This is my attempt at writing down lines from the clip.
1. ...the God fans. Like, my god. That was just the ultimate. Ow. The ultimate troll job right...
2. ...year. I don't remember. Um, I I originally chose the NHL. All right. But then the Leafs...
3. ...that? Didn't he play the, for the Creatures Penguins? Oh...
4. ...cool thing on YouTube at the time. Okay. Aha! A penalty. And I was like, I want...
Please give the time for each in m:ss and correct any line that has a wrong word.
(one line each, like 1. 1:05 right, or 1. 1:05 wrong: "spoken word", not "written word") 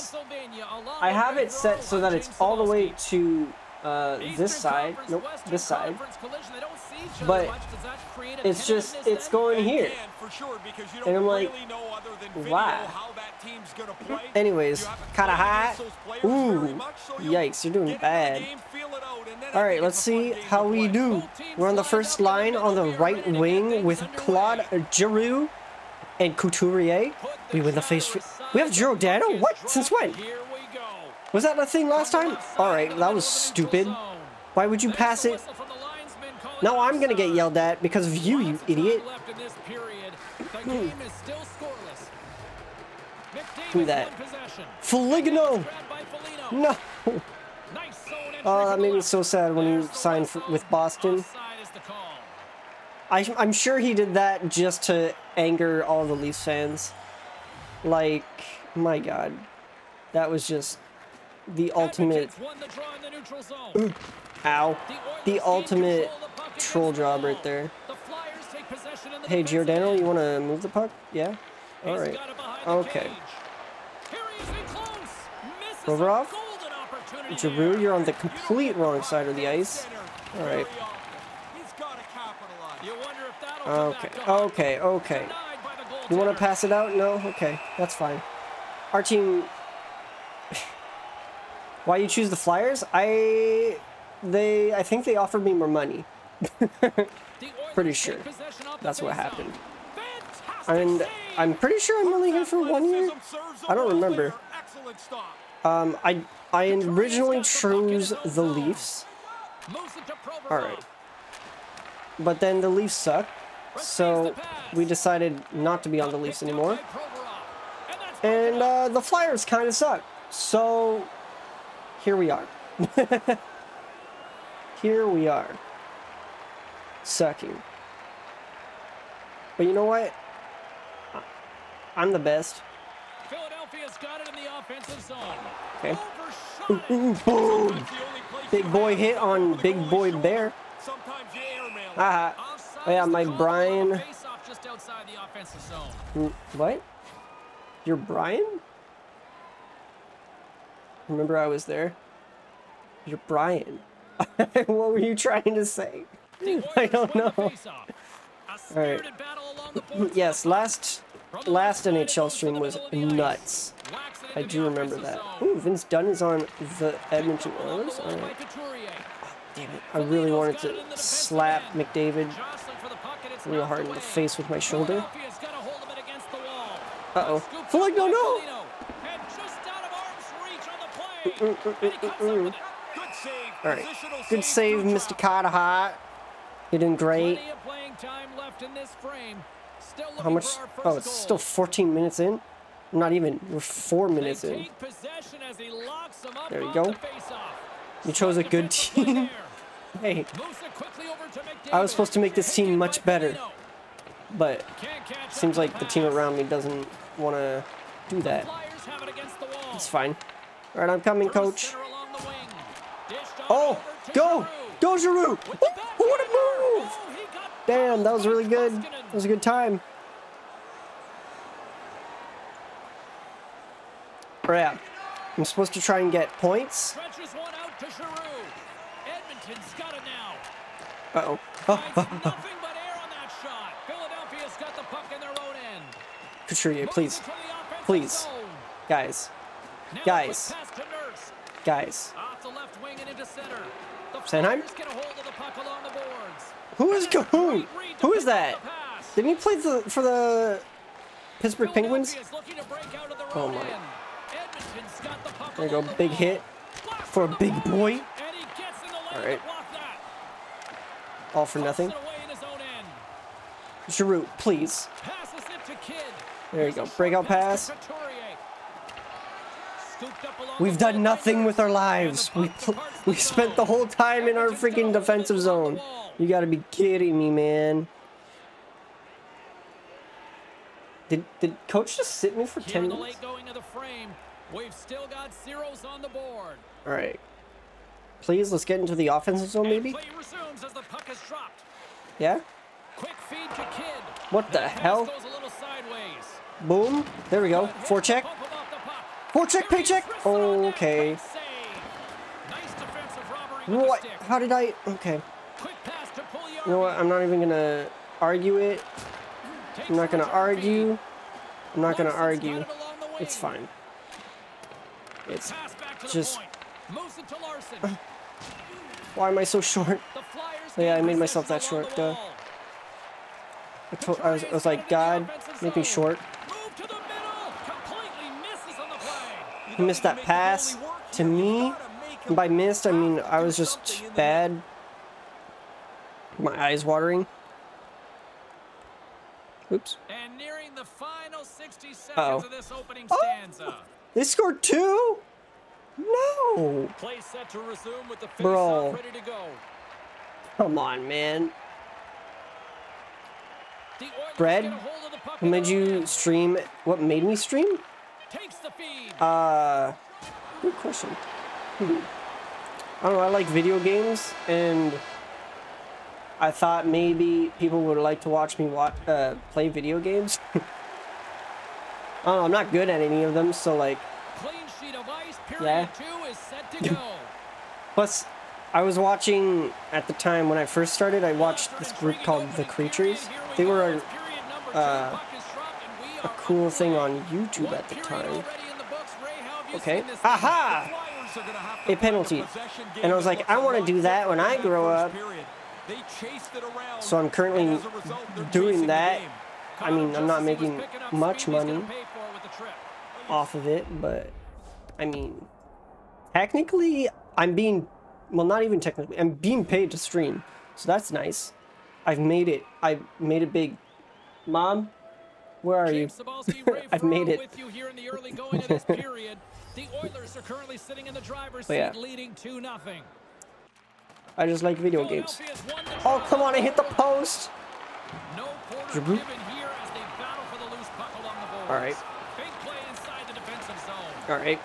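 1. 0:56 wrong: "Leafs", not "God"
2. 1:42 wrong: "Leafs", not "NHL"
3. 4:08 wrong: "Pittsburgh", not "Creatures"
4. 6:26 right.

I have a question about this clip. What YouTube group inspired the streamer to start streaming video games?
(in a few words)
The Creatures.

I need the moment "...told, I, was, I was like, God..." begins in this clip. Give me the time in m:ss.
5:23.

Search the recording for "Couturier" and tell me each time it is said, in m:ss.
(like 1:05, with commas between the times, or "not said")
0:26, 3:56.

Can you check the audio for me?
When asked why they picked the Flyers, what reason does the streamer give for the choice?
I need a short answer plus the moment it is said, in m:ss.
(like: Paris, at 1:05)
More money, at 1:35.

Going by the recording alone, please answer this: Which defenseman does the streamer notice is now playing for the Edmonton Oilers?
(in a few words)
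Vince Dunn.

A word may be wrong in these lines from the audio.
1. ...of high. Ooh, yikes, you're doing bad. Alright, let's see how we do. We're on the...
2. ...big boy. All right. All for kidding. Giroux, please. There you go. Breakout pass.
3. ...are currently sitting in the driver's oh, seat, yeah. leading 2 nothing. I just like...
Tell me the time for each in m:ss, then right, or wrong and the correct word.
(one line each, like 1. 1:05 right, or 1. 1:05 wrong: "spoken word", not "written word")
1. 0:15 right
2. 4:17 wrong: "nothing", not "kidding"
3. 7:00 right.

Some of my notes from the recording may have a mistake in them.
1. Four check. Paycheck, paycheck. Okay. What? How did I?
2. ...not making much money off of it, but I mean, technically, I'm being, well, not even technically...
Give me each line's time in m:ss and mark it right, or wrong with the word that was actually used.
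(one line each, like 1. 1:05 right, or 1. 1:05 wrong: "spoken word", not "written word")
1. 4:57 right
2. 6:40 right.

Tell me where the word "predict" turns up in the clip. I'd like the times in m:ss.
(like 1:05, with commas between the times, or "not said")
not said.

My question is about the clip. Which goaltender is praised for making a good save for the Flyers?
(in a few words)
Carter Hart.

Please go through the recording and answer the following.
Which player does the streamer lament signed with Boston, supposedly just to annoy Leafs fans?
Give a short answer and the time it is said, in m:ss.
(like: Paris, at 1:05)
Foligno, at 0:44.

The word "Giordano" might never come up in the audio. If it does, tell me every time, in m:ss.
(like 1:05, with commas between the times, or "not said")
1:09.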